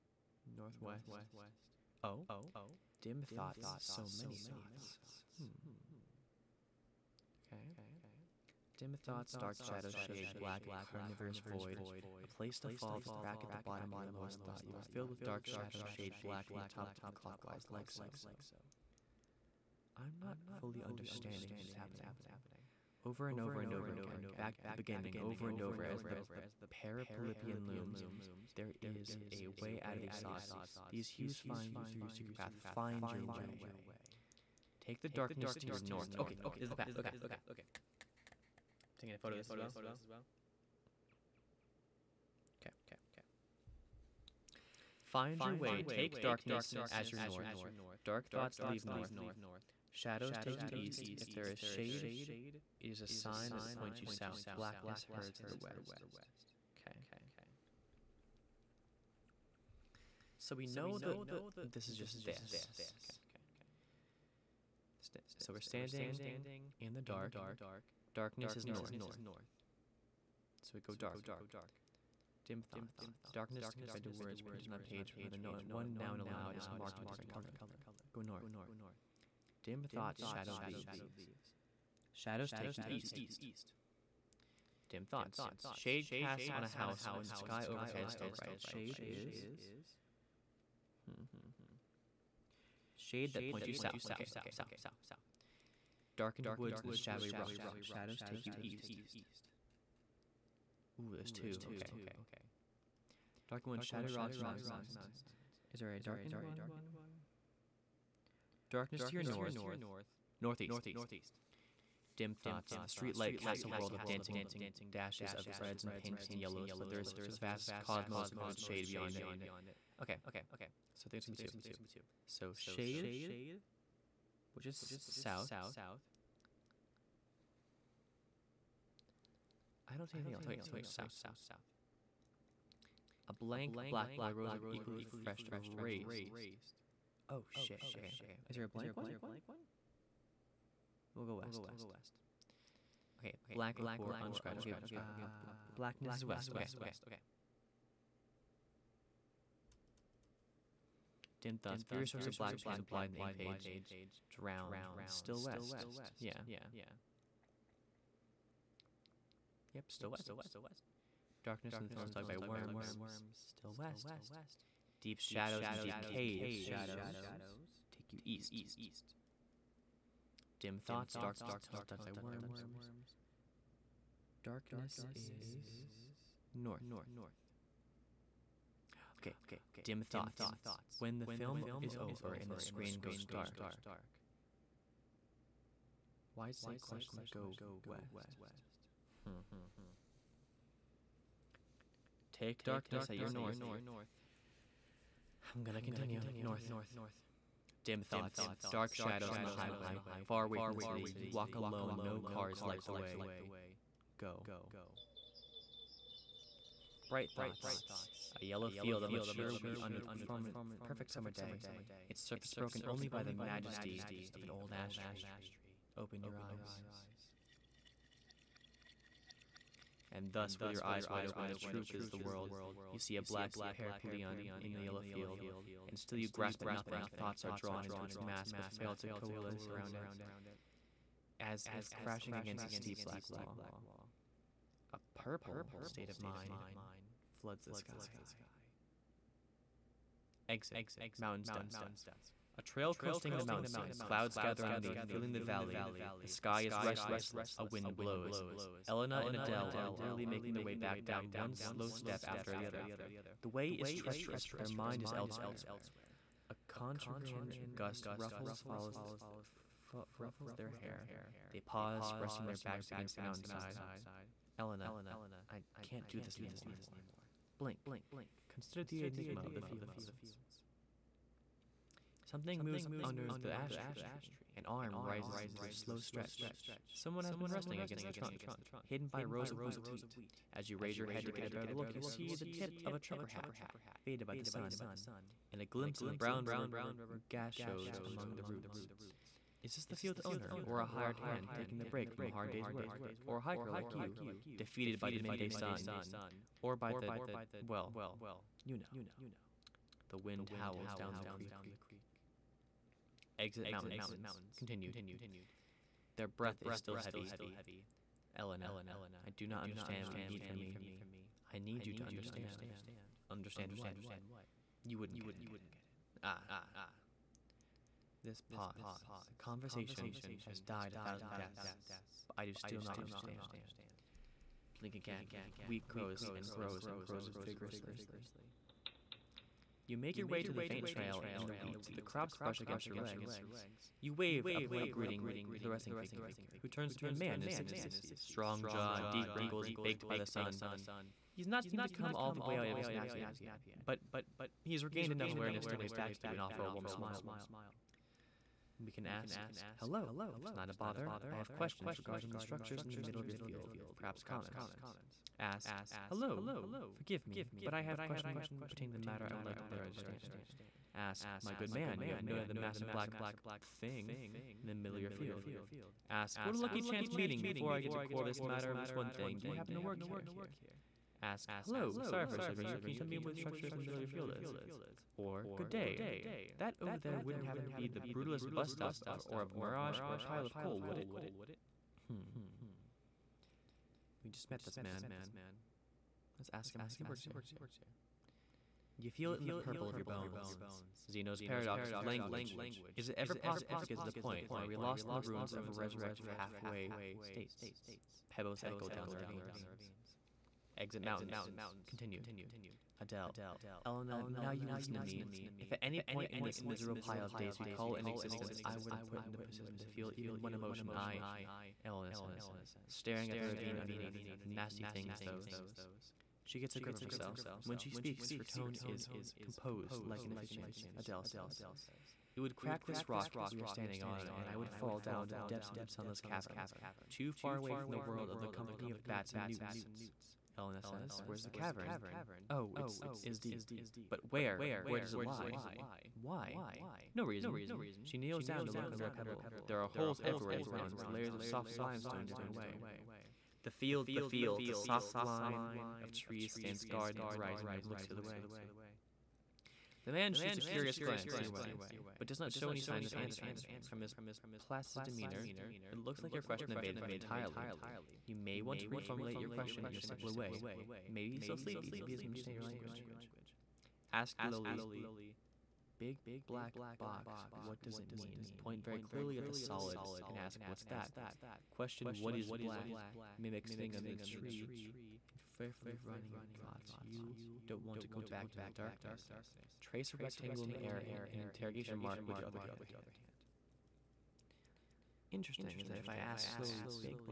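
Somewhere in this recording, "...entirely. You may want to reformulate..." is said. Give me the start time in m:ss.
7:37.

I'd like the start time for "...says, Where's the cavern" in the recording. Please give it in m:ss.
7:10.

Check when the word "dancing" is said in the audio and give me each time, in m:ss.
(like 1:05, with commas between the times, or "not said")
1:54.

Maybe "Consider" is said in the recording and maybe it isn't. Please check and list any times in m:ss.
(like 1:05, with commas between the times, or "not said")
4:28.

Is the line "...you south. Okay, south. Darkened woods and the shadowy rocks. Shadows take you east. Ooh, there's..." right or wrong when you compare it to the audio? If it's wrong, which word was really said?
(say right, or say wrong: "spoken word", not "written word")
right.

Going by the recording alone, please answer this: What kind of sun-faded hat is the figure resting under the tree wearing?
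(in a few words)
Trucker hat.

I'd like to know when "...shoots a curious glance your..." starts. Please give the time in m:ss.
7:30.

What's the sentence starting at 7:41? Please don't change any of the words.
Maybe he doesn't understand your language.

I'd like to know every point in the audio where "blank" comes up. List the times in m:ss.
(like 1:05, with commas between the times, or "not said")
2:13, 2:18.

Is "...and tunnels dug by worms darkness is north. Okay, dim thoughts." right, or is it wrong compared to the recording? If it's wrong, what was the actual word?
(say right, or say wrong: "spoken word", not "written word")
right.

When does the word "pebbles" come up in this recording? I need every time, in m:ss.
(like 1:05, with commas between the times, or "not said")
6:38, 7:19.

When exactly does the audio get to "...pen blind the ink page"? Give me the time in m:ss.
2:32.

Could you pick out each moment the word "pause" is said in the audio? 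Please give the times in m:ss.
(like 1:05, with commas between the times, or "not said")
4:21, 5:18.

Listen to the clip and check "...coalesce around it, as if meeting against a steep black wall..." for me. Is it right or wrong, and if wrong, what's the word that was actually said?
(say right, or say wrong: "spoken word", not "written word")
wrong: "crashing", not "meeting".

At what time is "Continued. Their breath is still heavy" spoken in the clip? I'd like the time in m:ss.
5:04.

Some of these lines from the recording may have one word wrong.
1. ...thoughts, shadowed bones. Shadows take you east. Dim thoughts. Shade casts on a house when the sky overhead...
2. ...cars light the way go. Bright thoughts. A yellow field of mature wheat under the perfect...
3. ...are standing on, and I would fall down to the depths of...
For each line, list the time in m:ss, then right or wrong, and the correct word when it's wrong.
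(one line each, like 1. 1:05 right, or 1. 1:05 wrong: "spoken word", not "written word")
1. 1:19 wrong: "leaves", not "bones"
2. 3:22 right
3. 7:03 right.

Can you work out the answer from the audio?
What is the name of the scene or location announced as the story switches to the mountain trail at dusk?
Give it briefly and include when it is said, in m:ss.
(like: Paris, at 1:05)
Mountain's Dusk, at 4:00.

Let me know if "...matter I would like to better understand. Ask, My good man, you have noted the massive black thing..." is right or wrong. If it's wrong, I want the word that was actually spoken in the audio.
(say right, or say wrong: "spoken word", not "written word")
right.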